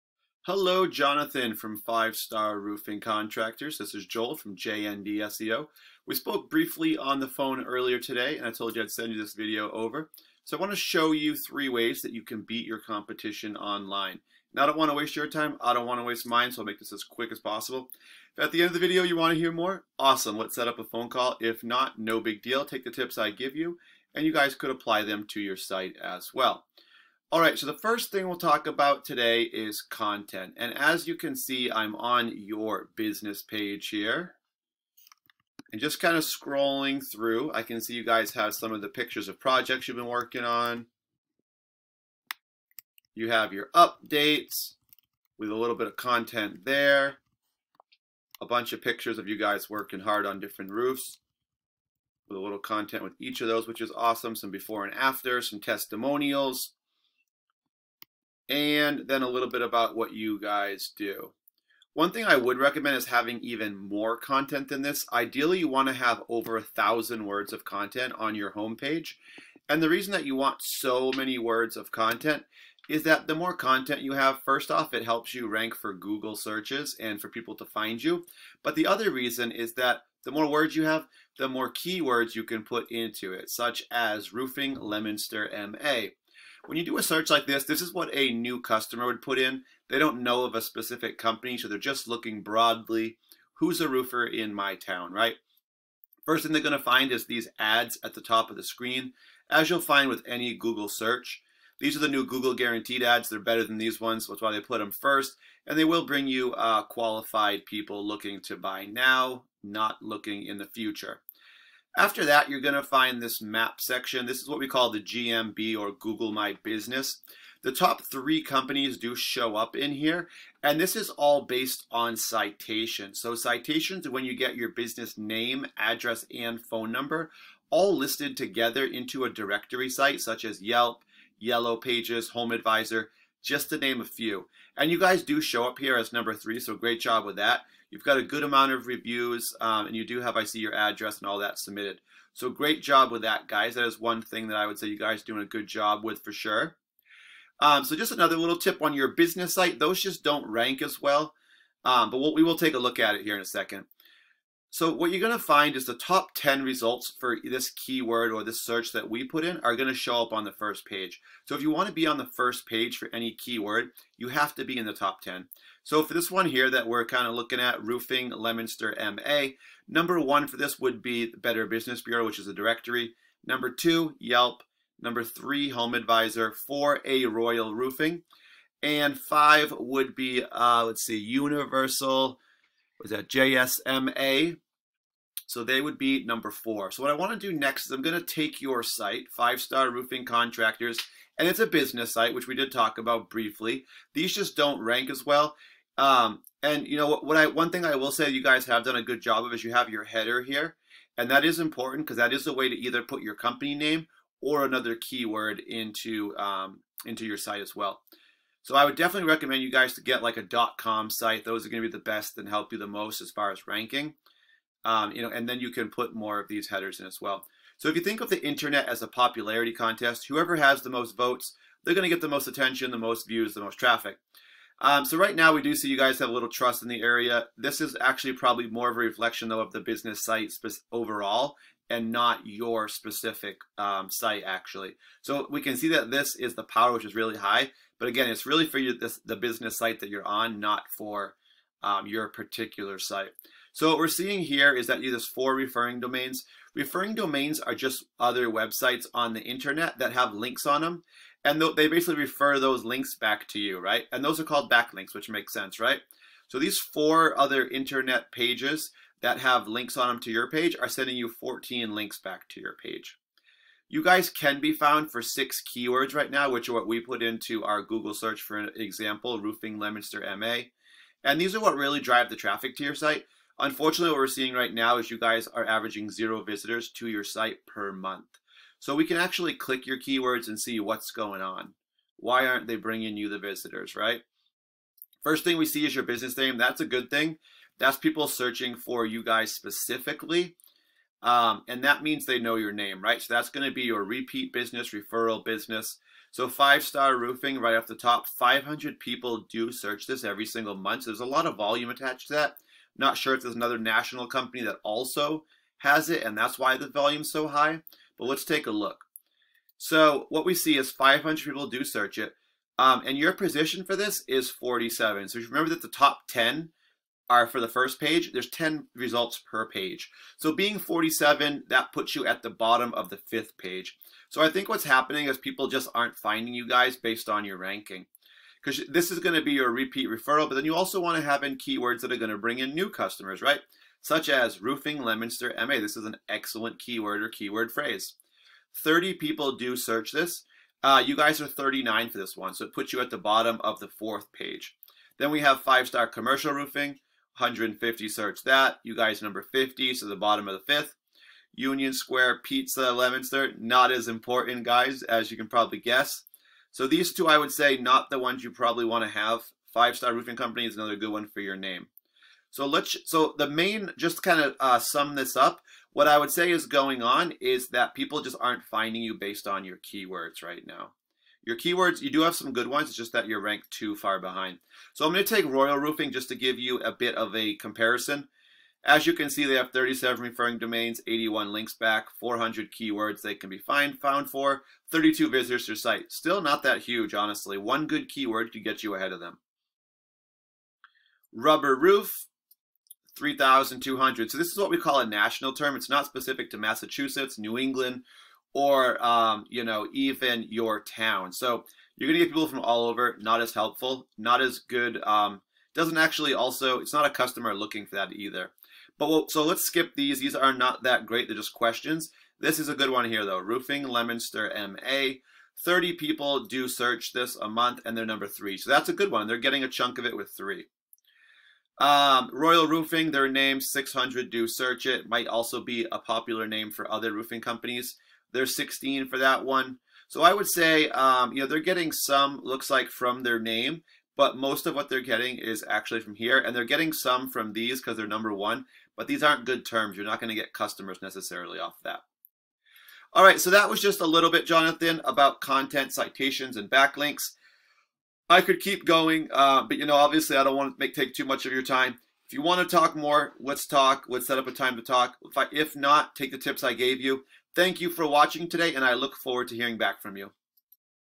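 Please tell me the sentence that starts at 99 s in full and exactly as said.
As you'll find with any Google search, these are the new Google guaranteed ads.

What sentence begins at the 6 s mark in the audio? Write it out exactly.
We spoke briefly on the phone earlier today, and I told you I'd send you this video over.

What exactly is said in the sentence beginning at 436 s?
And they're getting some from these because they're number one, but these aren't good terms.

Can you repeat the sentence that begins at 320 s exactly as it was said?
So being 47, that puts you at the bottom of the fifth page.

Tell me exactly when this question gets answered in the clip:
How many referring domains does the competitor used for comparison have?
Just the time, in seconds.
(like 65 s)
379 s.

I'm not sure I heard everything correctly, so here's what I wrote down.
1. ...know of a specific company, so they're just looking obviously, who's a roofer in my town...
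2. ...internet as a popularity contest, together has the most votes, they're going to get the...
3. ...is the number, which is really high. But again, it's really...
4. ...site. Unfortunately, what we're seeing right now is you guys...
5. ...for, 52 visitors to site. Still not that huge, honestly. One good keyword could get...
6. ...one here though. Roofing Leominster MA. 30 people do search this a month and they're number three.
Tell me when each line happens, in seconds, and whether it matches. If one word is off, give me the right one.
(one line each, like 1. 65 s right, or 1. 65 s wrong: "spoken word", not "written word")
1. 90 s wrong: "broadly", not "obviously"
2. 218 s wrong: "whoever", not "together"
3. 236 s wrong: "power", not "number"
4. 272 s right
5. 384 s wrong: "32", not "52"
6. 412 s right.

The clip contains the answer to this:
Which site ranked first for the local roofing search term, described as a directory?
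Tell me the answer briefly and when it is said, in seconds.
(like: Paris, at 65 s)
Better Business Bureau, at 171 s.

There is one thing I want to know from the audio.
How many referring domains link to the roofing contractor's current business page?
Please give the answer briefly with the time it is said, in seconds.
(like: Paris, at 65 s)
4, at 245 s.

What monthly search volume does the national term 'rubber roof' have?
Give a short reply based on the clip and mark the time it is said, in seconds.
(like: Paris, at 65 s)
3,200, at 393 s.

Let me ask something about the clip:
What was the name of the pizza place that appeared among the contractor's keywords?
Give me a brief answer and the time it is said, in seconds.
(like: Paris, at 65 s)
Union Square Pizza, at 351 s.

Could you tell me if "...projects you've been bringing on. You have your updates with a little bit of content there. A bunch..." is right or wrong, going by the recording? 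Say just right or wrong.
wrong.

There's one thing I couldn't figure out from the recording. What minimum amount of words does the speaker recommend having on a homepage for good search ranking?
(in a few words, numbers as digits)
1,000.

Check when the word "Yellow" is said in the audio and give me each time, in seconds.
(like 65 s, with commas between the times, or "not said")
131 s.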